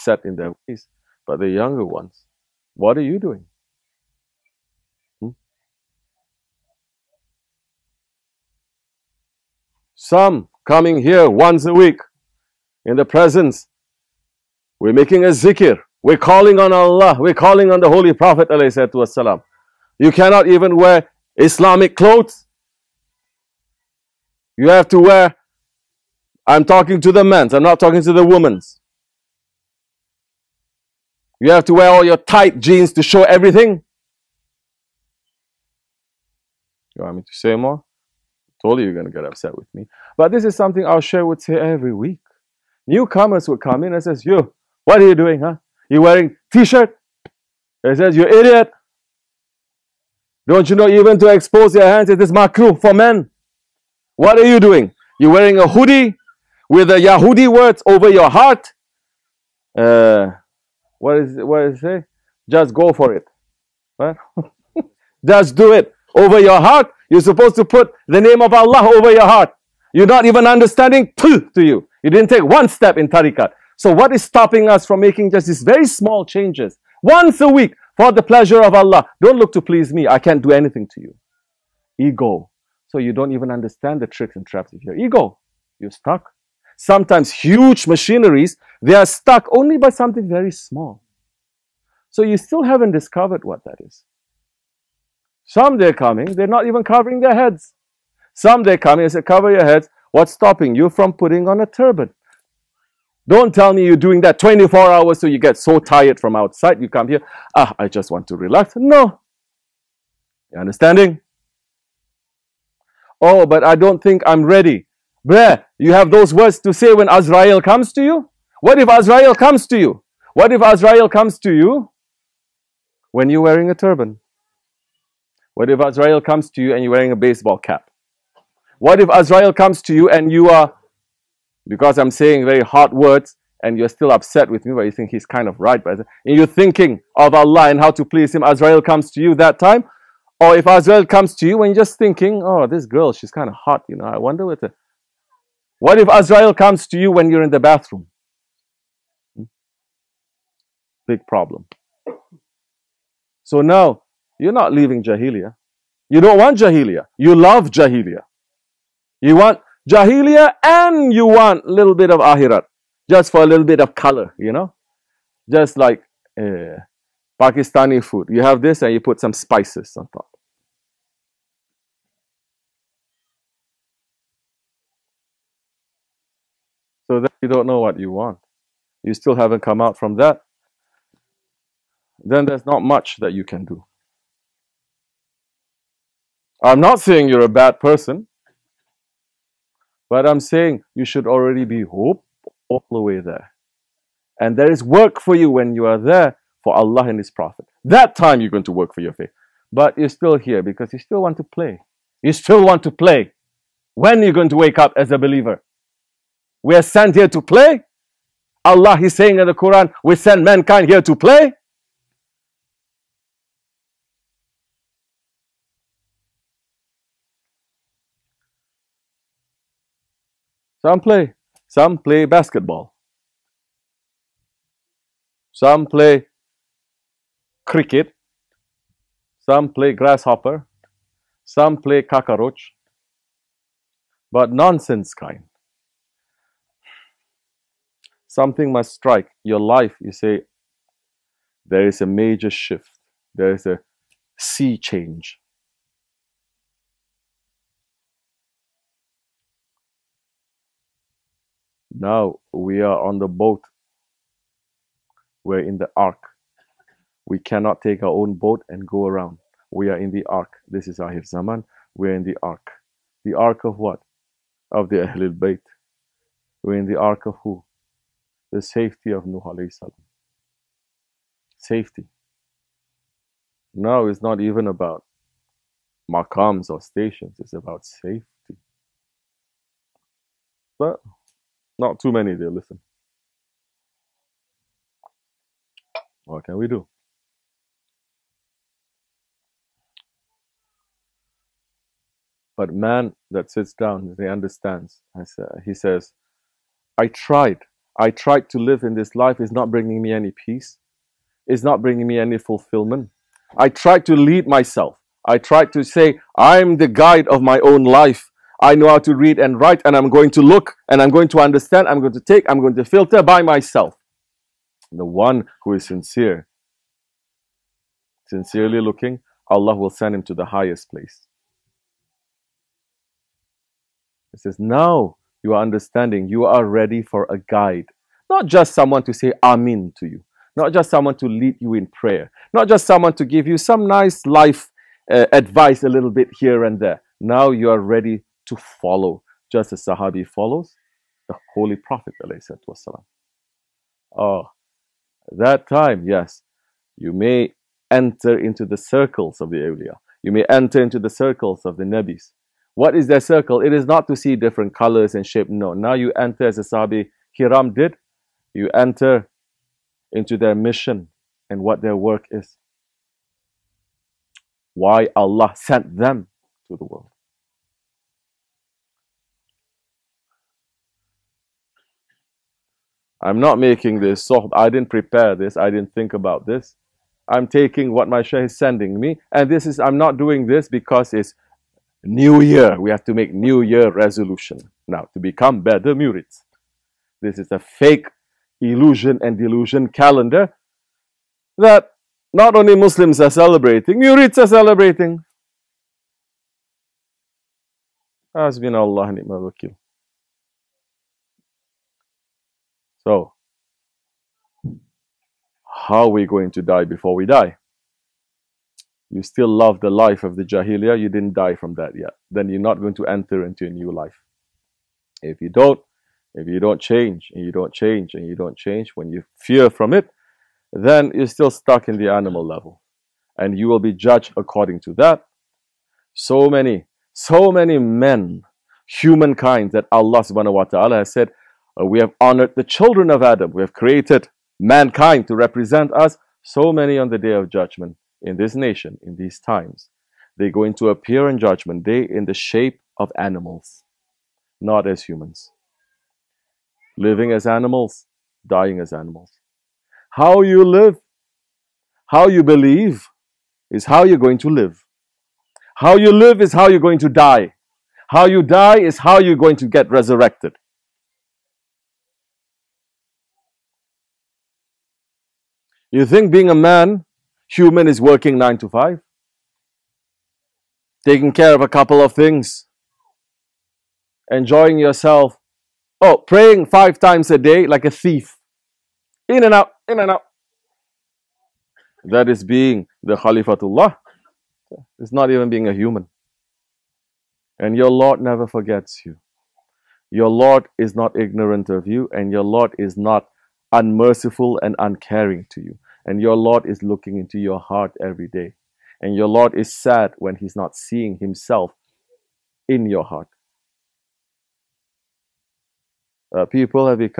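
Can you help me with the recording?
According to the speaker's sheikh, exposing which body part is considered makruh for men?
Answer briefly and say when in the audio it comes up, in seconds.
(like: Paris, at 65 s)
hands, at 51 s.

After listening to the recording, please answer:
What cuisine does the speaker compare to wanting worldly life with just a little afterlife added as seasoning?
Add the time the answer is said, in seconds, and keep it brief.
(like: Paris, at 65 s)
Pakistani food, at 167 s.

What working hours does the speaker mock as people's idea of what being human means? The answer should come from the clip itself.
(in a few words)
nine to five.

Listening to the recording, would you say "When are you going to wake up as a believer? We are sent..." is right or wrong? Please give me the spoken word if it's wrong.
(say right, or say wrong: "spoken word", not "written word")
right.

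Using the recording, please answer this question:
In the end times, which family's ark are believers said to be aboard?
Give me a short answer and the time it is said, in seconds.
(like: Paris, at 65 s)
Ahlul Bayt, at 264 s.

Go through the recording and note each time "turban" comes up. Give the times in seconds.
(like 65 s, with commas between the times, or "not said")
101 s, 123 s.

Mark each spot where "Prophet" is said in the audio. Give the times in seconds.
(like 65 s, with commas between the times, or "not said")
18 s, 197 s, 341 s.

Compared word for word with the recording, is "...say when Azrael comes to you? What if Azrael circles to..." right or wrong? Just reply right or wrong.
wrong.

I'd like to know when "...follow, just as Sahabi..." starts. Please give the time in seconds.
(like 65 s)
338 s.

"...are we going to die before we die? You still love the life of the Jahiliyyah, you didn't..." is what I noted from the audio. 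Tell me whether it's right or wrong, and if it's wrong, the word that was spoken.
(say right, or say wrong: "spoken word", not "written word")
right.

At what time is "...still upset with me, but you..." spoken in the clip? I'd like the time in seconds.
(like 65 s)
133 s.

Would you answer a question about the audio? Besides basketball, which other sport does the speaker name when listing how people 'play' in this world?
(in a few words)
cricket.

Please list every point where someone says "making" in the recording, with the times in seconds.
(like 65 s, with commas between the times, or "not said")
14 s, 74 s, 373 s.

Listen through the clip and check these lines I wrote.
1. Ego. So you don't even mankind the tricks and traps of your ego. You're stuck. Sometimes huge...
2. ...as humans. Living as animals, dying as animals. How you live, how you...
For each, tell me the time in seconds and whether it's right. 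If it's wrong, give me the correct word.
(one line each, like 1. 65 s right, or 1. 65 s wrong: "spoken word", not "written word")
1. 81 s wrong: "understand", not "mankind"
2. 444 s right.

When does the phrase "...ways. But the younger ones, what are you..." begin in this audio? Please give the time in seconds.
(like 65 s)
0 s.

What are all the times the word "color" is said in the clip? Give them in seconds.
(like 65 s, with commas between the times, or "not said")
163 s, 354 s.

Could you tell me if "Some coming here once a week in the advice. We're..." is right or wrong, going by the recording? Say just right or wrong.
wrong.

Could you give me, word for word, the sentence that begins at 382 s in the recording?
We have to make new year resolution now to become better murids.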